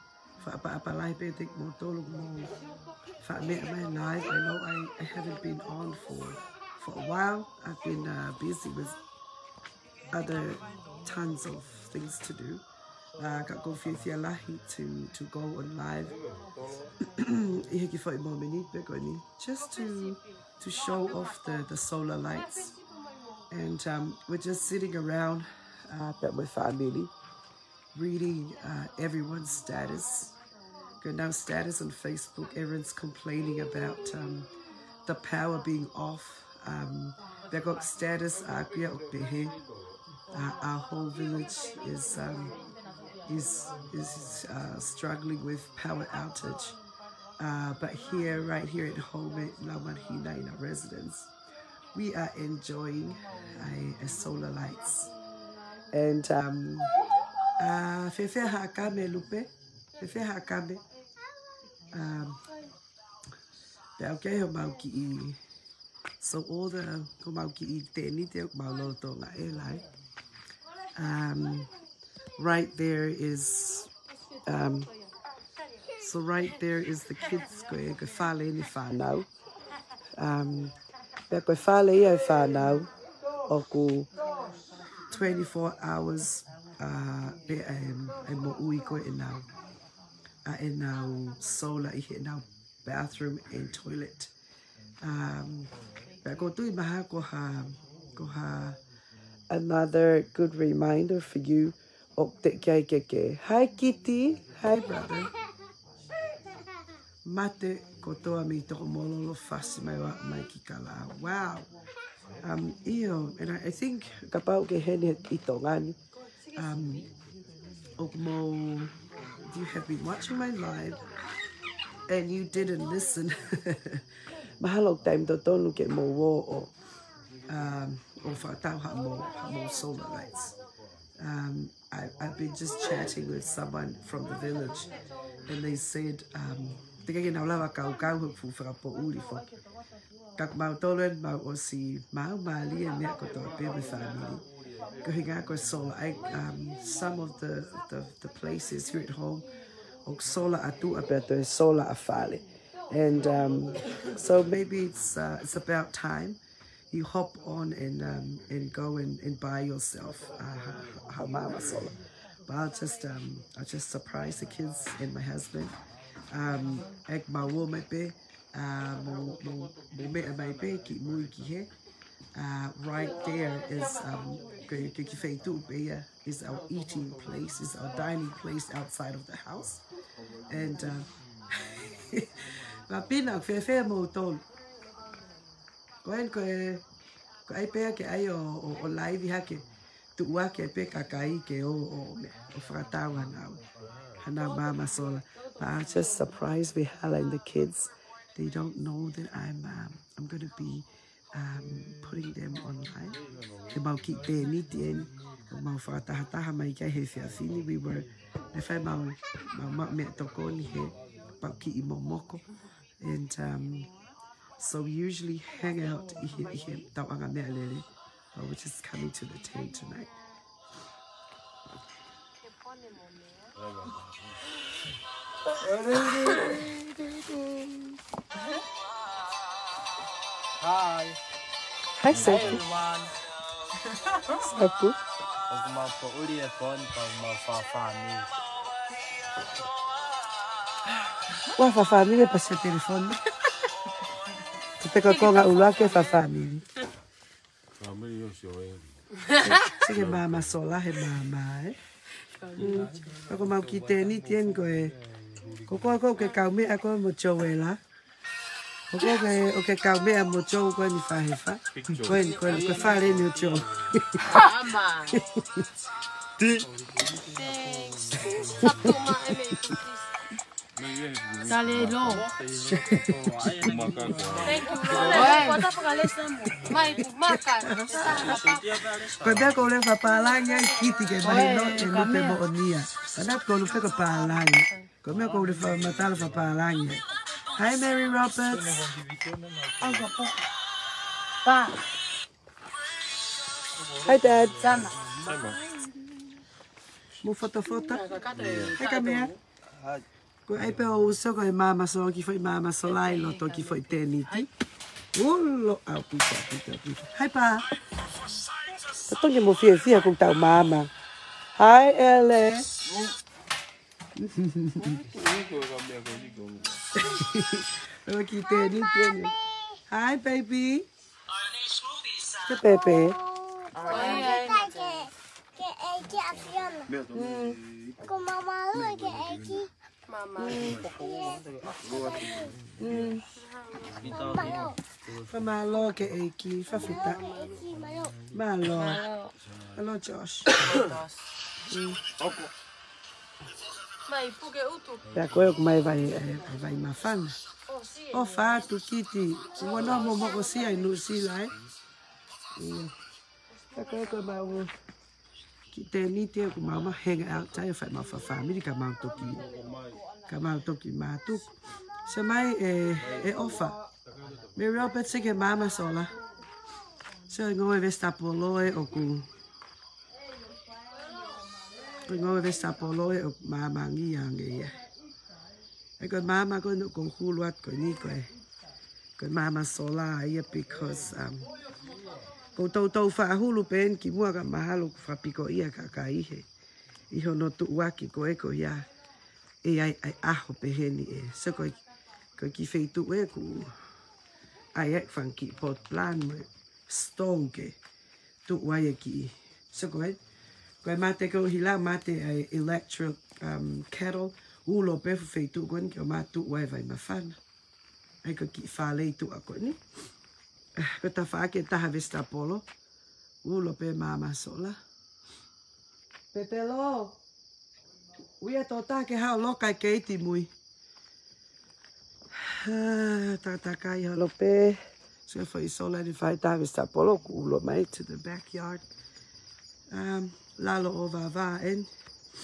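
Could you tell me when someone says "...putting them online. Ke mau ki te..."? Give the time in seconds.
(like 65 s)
202 s.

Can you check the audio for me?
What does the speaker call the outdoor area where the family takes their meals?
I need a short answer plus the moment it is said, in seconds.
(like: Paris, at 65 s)
Dining place, at 177 s.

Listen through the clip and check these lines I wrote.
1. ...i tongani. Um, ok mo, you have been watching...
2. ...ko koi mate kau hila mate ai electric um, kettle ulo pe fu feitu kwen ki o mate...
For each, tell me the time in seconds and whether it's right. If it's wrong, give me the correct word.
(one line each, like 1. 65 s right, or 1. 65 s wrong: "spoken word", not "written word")
1. 115 s right
2. 399 s right.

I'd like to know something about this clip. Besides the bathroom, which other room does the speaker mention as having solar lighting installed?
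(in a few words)
Toilet.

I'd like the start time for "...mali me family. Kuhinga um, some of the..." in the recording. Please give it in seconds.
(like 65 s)
142 s.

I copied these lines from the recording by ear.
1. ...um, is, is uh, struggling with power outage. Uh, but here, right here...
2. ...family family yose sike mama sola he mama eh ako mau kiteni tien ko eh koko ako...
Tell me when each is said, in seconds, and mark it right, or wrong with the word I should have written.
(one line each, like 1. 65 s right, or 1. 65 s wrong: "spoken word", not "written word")
1. 42 s right
2. 246 s right.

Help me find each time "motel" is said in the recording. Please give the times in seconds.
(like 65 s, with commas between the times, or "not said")
183 s.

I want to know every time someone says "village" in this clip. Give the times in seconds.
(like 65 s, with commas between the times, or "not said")
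41 s, 134 s.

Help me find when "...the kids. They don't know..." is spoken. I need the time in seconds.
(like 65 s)
197 s.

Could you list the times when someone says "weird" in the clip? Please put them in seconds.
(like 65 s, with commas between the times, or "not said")
not said.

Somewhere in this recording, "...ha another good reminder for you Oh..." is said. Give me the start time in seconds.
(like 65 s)
98 s.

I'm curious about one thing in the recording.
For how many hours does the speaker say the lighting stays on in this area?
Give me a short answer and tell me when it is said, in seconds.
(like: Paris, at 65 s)
24, at 85 s.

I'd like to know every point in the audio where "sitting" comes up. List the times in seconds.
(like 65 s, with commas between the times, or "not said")
24 s.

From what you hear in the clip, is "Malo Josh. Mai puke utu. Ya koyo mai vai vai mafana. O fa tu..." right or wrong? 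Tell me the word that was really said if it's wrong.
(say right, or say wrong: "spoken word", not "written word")
right.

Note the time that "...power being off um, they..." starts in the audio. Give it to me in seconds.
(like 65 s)
35 s.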